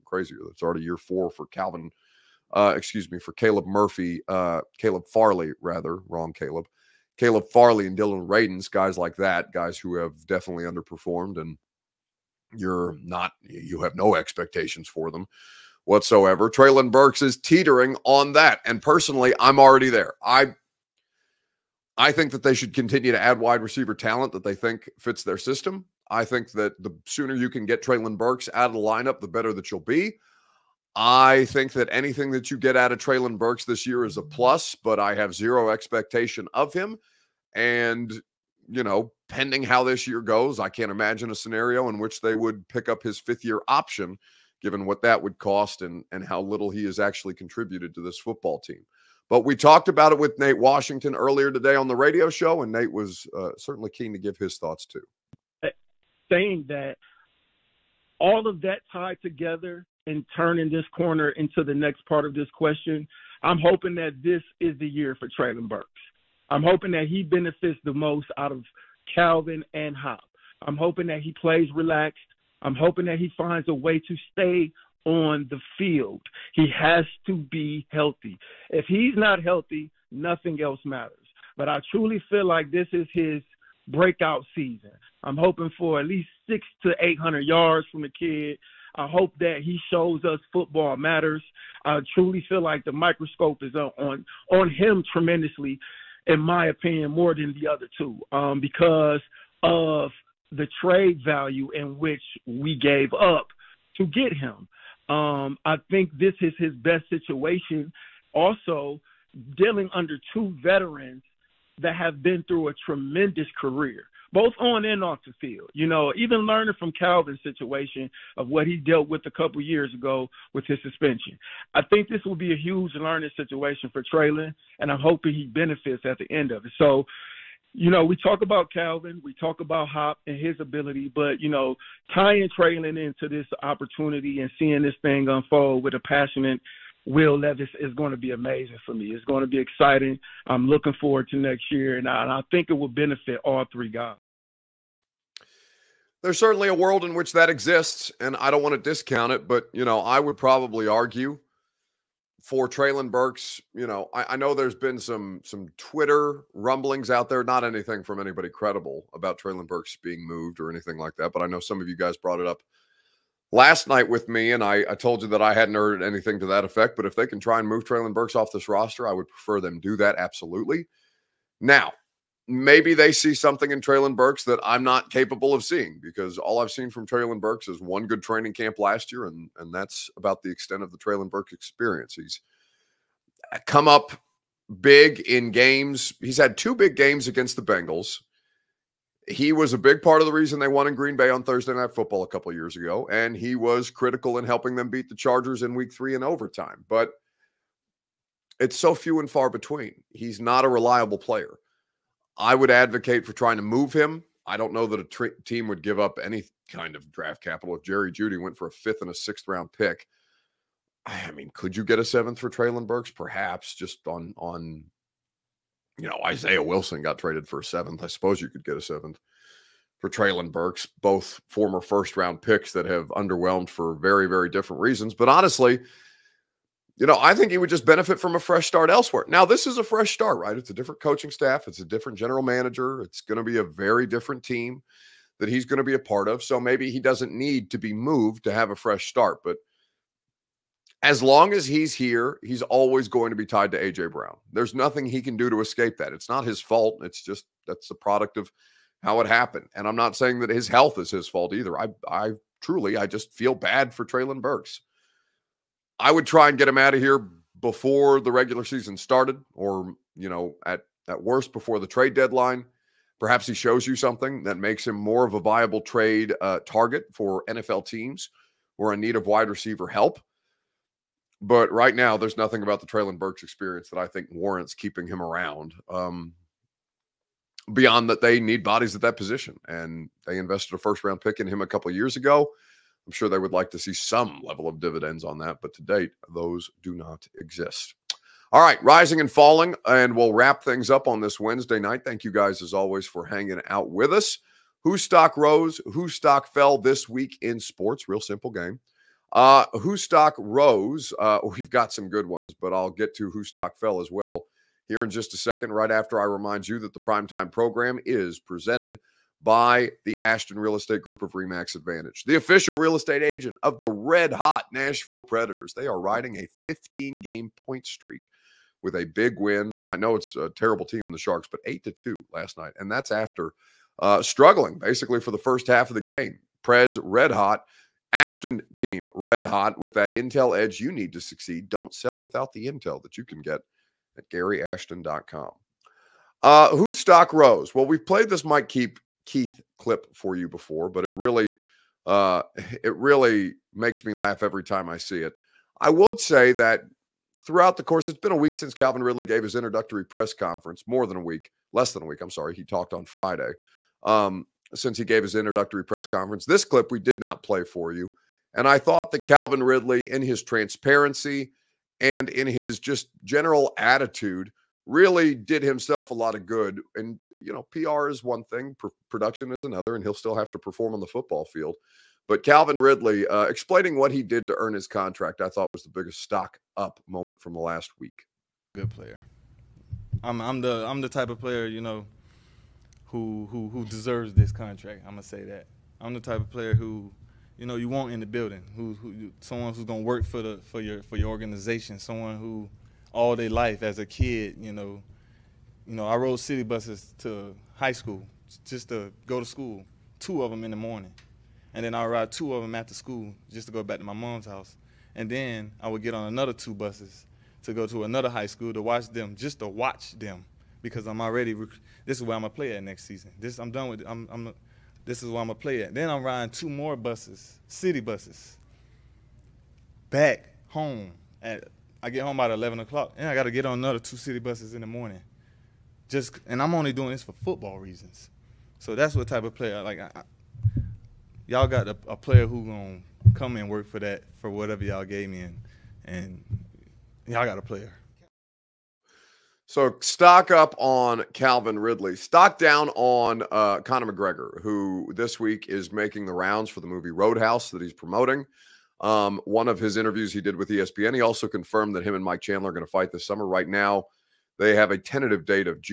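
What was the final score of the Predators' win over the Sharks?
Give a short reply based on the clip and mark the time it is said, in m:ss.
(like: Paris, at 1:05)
8 to 2, at 5:21.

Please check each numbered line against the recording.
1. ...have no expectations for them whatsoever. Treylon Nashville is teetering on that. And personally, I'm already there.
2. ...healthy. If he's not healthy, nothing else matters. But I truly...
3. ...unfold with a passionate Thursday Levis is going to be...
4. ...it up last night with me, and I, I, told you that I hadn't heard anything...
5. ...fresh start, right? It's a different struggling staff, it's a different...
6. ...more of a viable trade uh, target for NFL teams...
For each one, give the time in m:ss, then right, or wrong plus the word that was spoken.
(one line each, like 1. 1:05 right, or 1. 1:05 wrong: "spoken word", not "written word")
1. 0:13 wrong: "Burks", not "Nashville"
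2. 1:17 right
3. 2:15 wrong: "Will", not "Thursday"
4. 2:42 right
5. 3:49 wrong: "coaching", not "struggling"
6. 4:24 right.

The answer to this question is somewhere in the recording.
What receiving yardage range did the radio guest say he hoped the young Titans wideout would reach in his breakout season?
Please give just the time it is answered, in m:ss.
1:26.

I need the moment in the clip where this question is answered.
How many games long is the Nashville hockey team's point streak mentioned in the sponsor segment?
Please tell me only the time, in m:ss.
5:16.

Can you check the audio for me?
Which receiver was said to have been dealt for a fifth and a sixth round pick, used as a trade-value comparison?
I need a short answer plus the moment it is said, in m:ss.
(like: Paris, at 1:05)
Jerry Jeudy, at 3:27.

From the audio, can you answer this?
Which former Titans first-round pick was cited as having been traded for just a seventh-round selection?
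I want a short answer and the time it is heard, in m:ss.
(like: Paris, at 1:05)
Isaiah Wilson, at 3:36.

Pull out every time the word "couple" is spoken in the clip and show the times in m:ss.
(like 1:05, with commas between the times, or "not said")
1:59, 3:12, 4:41.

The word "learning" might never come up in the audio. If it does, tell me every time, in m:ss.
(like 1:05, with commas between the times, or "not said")
1:56, 2:02.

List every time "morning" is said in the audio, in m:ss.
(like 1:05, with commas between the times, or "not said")
6:40, 7:04.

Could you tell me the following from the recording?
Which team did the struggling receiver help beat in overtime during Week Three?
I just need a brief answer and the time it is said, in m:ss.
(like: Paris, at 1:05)
Chargers, at 3:15.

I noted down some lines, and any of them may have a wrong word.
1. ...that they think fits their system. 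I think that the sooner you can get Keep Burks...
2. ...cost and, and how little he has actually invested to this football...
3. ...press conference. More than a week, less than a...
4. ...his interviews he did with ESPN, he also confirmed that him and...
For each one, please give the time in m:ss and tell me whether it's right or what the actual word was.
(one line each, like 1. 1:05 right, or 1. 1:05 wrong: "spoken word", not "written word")
1. 0:24 wrong: "Treylon", not "Keep"
2. 0:45 wrong: "contributed", not "invested"
3. 5:50 right
4. 7:29 right.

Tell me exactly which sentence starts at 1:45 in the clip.
Um, I think this is his best situation.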